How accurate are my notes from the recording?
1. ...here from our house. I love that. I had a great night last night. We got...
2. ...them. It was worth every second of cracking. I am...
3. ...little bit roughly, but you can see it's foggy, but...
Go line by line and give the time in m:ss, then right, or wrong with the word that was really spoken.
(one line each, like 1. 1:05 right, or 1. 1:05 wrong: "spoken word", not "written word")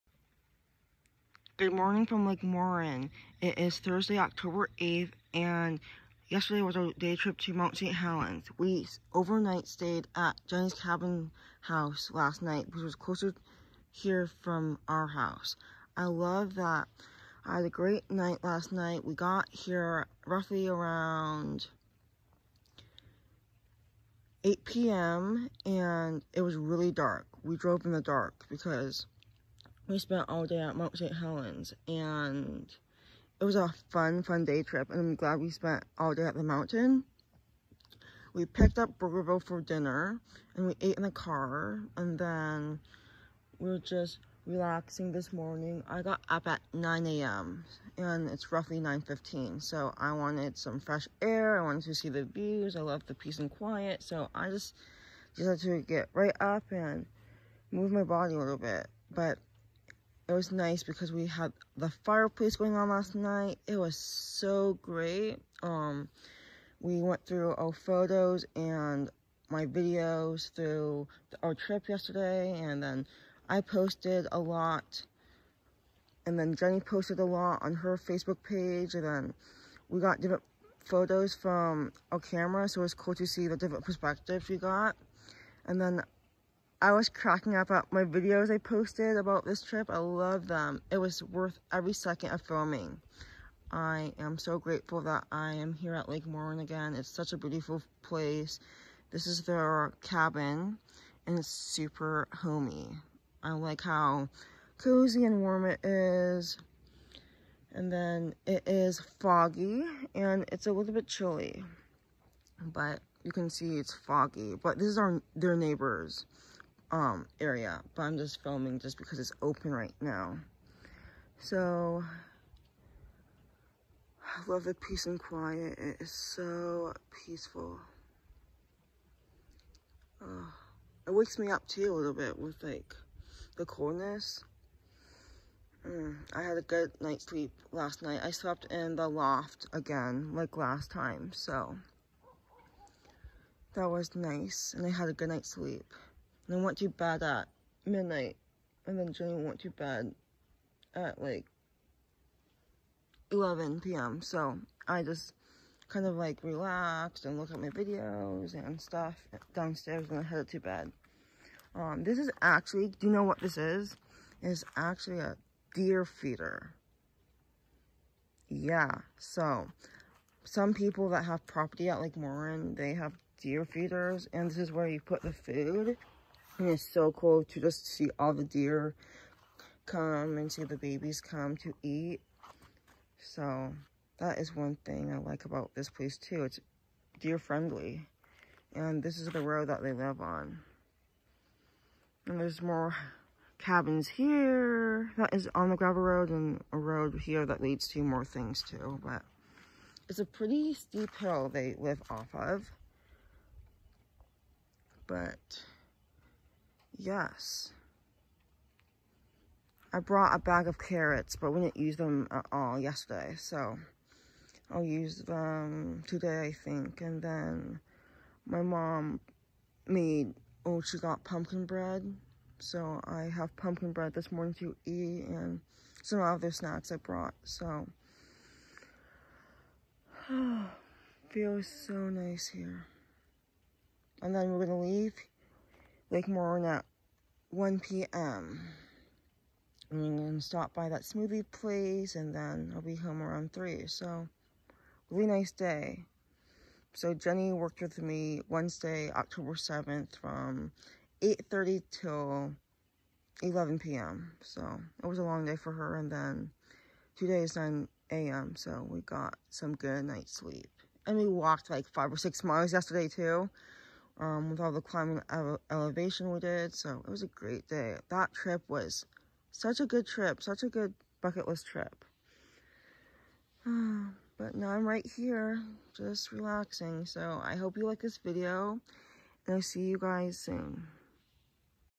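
1. 0:13 right
2. 1:30 wrong: "filming", not "cracking"
3. 1:50 wrong: "chilly", not "roughly".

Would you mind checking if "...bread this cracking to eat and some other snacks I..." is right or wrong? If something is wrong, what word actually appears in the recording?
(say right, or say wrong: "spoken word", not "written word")
wrong: "morning", not "cracking".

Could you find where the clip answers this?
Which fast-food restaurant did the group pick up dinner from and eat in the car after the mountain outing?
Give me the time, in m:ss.
0:38.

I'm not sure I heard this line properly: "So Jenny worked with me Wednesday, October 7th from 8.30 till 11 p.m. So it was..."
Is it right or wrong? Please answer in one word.
right.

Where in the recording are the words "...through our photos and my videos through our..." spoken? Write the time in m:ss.
1:07.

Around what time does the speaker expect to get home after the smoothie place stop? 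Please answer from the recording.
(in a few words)
3.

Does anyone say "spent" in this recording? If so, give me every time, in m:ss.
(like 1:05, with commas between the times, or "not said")
0:29, 0:35.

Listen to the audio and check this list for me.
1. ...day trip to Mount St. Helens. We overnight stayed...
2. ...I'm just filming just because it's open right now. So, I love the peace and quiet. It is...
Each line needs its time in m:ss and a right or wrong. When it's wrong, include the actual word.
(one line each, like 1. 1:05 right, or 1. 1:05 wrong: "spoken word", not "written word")
1. 0:06 right
2. 1:58 right.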